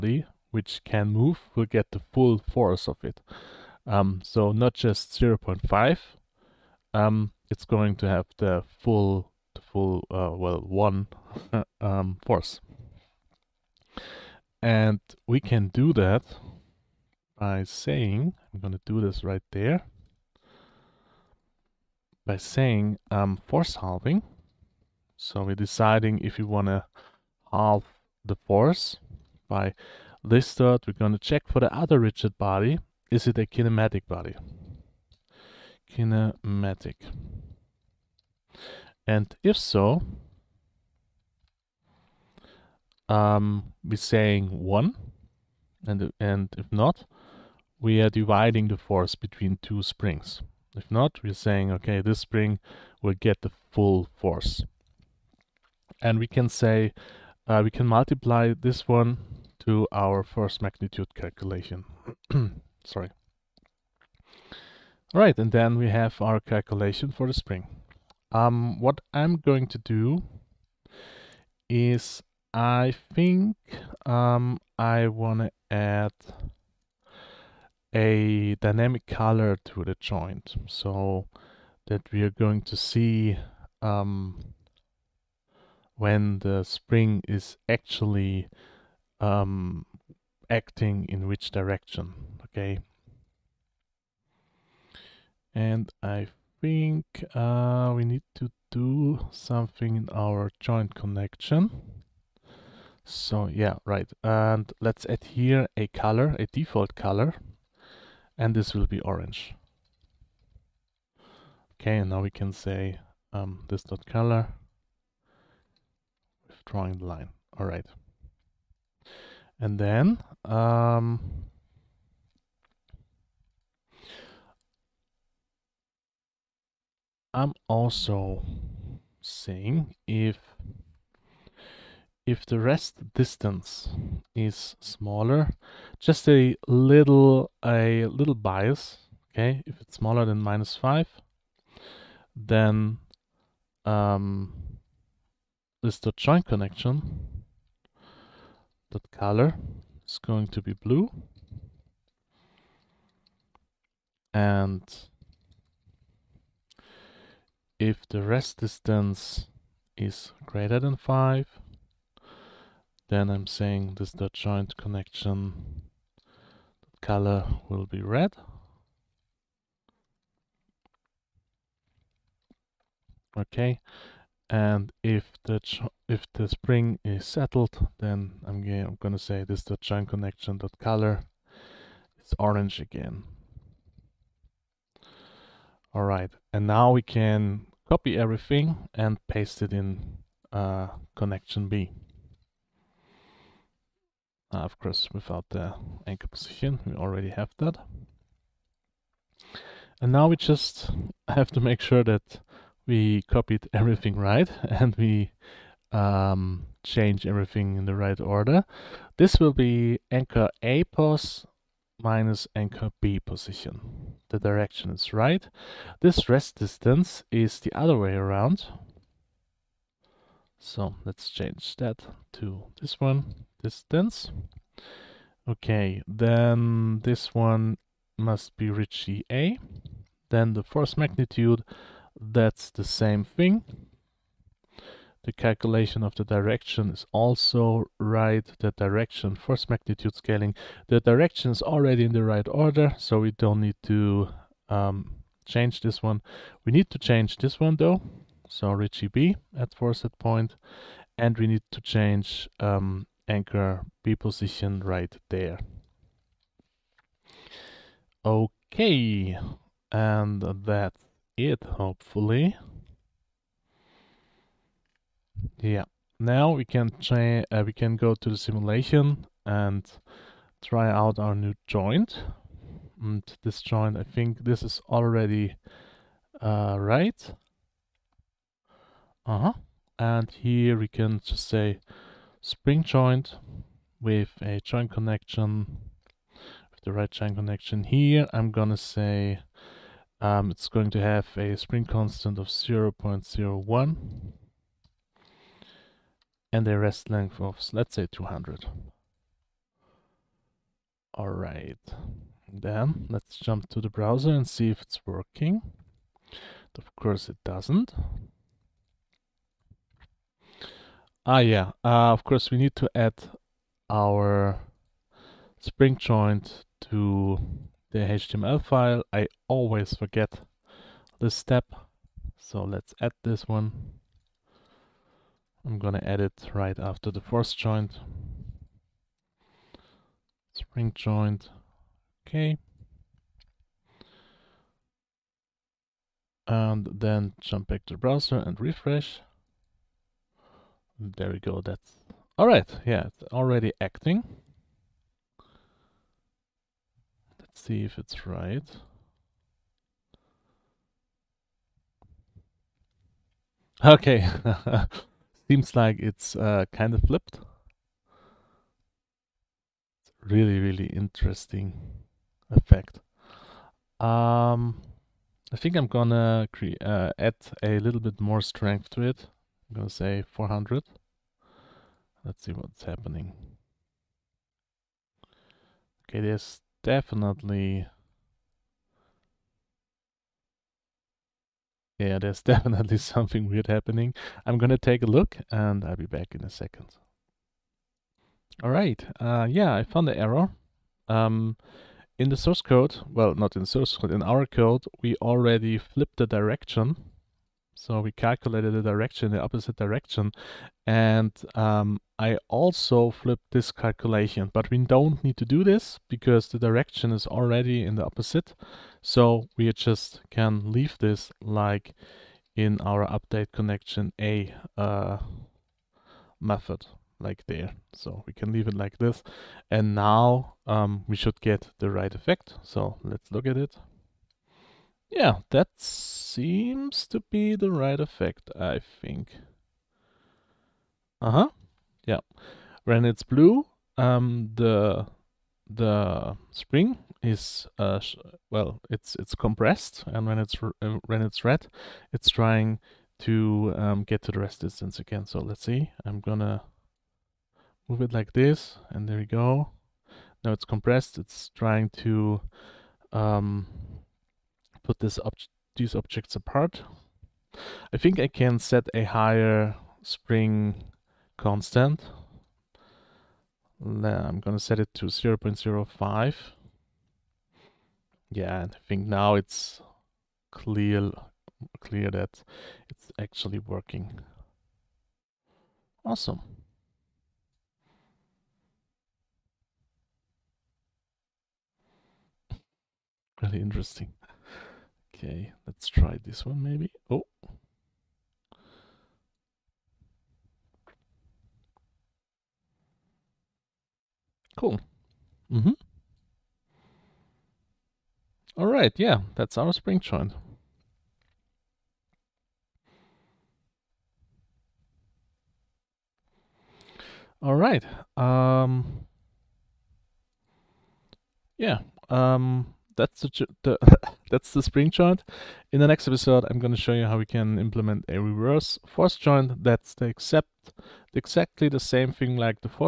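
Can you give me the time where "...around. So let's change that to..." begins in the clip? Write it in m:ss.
3:38.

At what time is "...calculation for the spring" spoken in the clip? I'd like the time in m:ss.
1:06.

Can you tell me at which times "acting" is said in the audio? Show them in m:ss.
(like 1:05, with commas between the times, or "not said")
1:30, 5:43.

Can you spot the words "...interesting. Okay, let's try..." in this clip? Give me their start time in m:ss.
8:03.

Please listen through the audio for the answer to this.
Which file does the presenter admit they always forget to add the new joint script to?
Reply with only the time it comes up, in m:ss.
5:17.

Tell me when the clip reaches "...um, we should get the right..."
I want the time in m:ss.
7:00.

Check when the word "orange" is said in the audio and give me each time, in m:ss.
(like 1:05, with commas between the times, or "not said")
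1:49, 3:02.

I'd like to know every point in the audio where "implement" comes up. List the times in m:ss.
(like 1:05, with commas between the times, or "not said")
8:37.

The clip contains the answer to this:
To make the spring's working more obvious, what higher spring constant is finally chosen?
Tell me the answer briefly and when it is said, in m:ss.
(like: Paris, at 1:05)
0.05, at 7:45.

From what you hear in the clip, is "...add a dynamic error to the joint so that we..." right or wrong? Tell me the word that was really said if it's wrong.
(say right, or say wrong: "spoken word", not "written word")
wrong: "color", not "error".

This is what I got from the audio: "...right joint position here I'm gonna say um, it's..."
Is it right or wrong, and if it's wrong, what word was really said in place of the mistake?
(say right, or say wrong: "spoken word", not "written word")
wrong: "connection", not "position".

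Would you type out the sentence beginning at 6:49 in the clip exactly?
So we just can leave this like in our update connection A uh, method like there.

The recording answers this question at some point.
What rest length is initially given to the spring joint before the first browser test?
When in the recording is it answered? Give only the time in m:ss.
4:57.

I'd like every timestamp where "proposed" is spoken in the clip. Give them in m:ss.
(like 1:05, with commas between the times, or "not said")
not said.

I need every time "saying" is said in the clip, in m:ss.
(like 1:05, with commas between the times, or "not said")
0:17, 0:22, 0:43, 0:51, 2:09, 2:43.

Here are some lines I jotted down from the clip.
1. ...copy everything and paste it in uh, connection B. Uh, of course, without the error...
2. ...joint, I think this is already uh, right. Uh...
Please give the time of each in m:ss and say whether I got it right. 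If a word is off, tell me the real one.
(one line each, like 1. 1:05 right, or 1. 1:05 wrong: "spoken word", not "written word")
1. 3:07 wrong: "anchor", not "error"
2. 4:33 right.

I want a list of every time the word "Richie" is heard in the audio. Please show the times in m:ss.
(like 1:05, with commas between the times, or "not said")
3:48, 4:08.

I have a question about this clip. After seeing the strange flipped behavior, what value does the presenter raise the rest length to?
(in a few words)
400.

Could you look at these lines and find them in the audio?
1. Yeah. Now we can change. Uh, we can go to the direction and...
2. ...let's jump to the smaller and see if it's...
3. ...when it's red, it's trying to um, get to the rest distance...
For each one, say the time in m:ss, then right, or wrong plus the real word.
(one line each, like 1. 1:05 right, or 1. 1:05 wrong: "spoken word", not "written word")
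1. 4:25 wrong: "simulation", not "direction"
2. 5:03 wrong: "browser", not "smaller"
3. 7:21 right.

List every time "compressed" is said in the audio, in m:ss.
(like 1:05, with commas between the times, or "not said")
7:19, 7:30.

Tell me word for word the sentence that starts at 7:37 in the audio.
I think I can set a higher spring constant.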